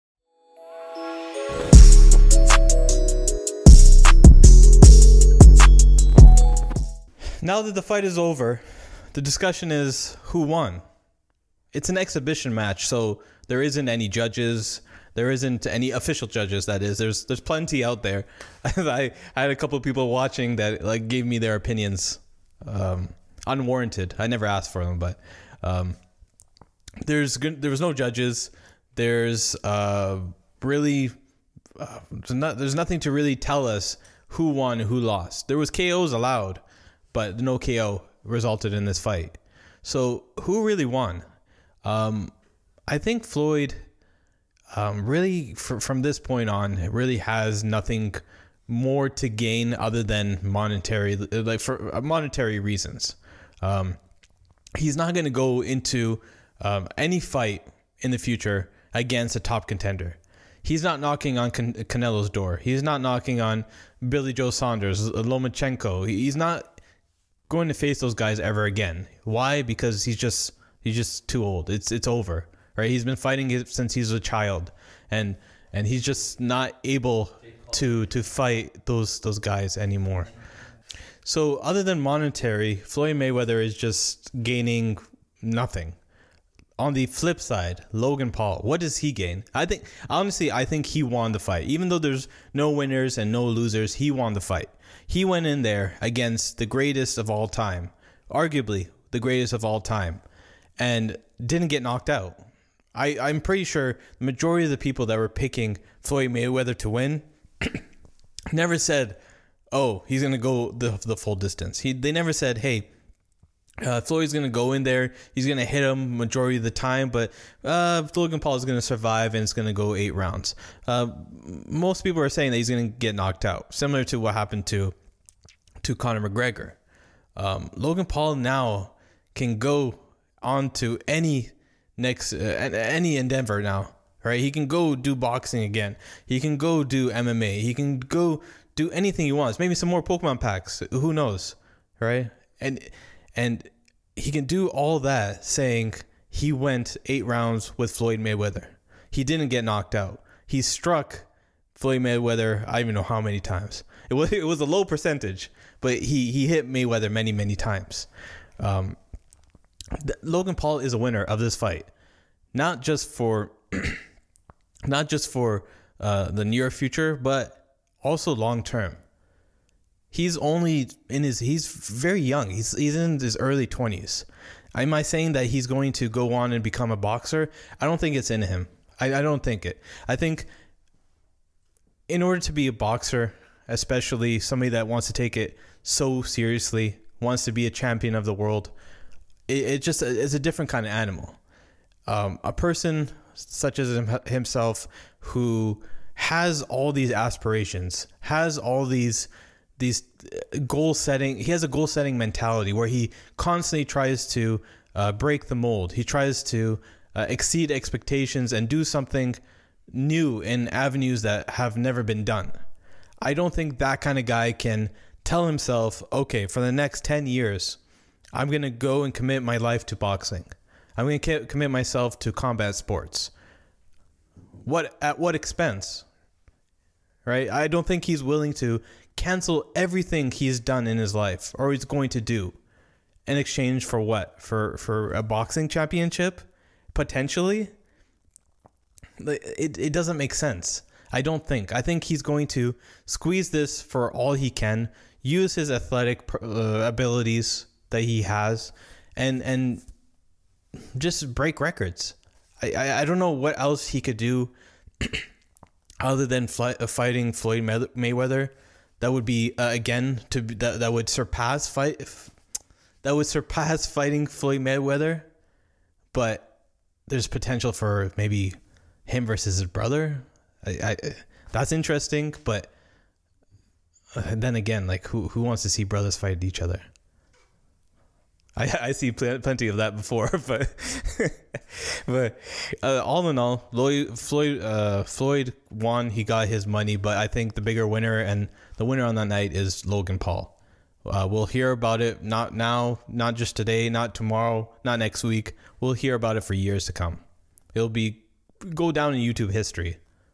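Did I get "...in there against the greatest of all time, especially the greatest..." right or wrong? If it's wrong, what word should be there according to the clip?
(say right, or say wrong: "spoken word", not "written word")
wrong: "arguably", not "especially".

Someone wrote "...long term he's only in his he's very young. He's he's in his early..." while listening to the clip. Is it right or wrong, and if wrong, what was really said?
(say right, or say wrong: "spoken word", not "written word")
right.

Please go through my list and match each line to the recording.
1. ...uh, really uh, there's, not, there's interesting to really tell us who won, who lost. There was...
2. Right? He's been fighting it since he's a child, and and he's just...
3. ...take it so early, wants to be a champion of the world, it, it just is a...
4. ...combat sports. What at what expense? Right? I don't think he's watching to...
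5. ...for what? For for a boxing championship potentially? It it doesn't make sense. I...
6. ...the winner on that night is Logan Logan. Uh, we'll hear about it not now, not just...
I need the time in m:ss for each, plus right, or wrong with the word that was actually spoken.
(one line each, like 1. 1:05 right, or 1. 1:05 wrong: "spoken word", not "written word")
1. 0:29 wrong: "nothing", not "interesting"
2. 1:12 right
3. 3:05 wrong: "seriously", not "early"
4. 3:42 wrong: "willing", not "watching"
5. 3:53 right
6. 4:48 wrong: "Paul", not "Logan".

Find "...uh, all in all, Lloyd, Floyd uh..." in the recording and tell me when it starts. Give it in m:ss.
4:42.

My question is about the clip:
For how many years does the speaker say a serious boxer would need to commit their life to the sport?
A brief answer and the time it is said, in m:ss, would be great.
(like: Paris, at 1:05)
10, at 3:37.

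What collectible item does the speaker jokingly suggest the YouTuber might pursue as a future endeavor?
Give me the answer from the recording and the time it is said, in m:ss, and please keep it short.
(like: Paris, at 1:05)
Pokemon packs, at 2:20.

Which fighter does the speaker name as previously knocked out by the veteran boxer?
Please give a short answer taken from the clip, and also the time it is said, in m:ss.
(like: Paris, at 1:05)
Conor McGregor, at 2:05.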